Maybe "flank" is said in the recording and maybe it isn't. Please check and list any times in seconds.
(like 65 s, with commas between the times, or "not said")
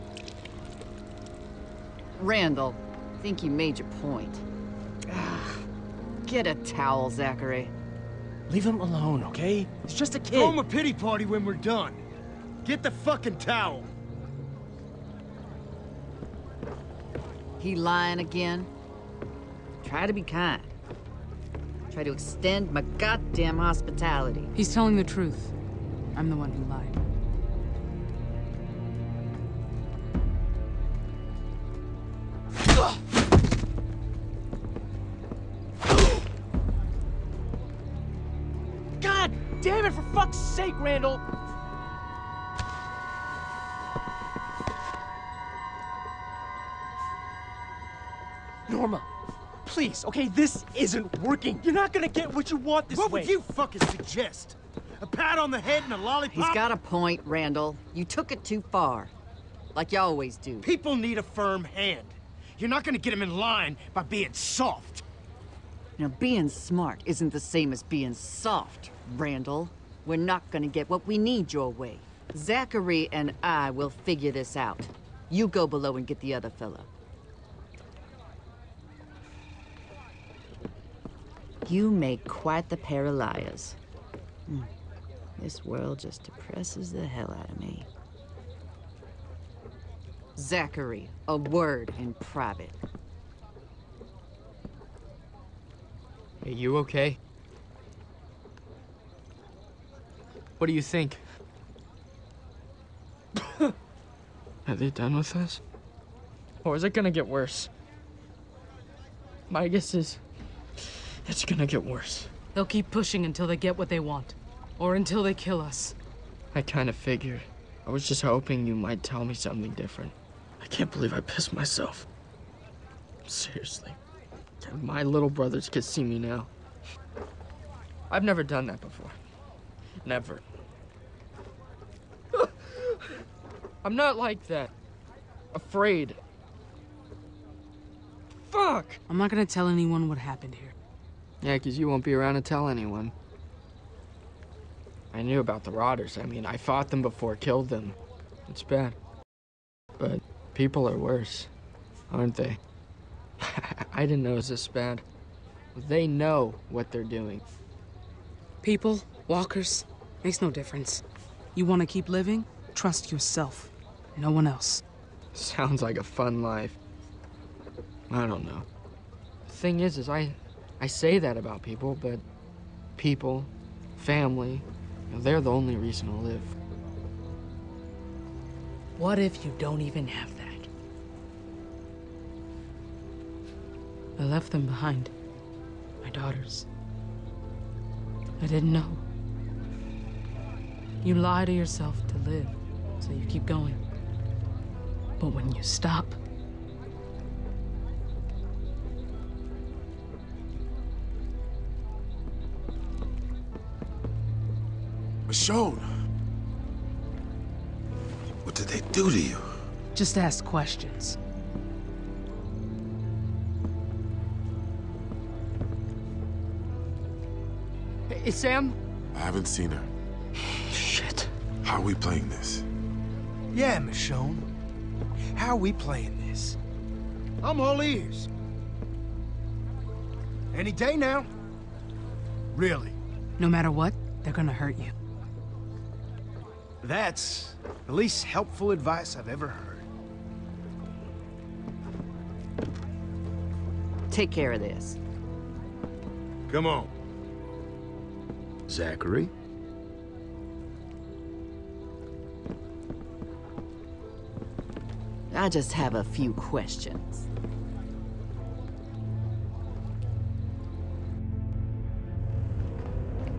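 not said.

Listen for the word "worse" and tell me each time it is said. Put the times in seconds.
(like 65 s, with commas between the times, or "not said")
107 s, 111 s, 150 s.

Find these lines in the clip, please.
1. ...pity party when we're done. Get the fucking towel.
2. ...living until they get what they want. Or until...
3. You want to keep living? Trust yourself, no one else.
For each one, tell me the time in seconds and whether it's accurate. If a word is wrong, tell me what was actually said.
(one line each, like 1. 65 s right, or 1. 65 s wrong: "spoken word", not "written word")
1. 10 s right
2. 112 s wrong: "pushing", not "living"
3. 161 s right.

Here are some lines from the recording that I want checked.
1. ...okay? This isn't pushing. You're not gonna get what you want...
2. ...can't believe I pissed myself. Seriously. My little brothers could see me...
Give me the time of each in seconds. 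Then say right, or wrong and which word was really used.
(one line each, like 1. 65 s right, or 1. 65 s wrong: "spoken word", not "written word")
1. 50 s wrong: "working", not "pushing"
2. 120 s right.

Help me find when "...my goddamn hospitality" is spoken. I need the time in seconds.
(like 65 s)
22 s.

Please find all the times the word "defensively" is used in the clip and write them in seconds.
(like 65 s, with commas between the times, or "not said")
not said.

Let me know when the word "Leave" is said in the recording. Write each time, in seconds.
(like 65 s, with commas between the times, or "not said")
8 s.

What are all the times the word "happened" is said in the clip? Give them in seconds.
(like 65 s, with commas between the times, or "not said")
140 s.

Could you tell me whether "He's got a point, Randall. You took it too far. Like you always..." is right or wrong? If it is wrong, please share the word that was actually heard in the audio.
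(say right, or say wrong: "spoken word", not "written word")
right.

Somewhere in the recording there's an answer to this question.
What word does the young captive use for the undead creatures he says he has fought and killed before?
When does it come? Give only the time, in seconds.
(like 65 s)
145 s.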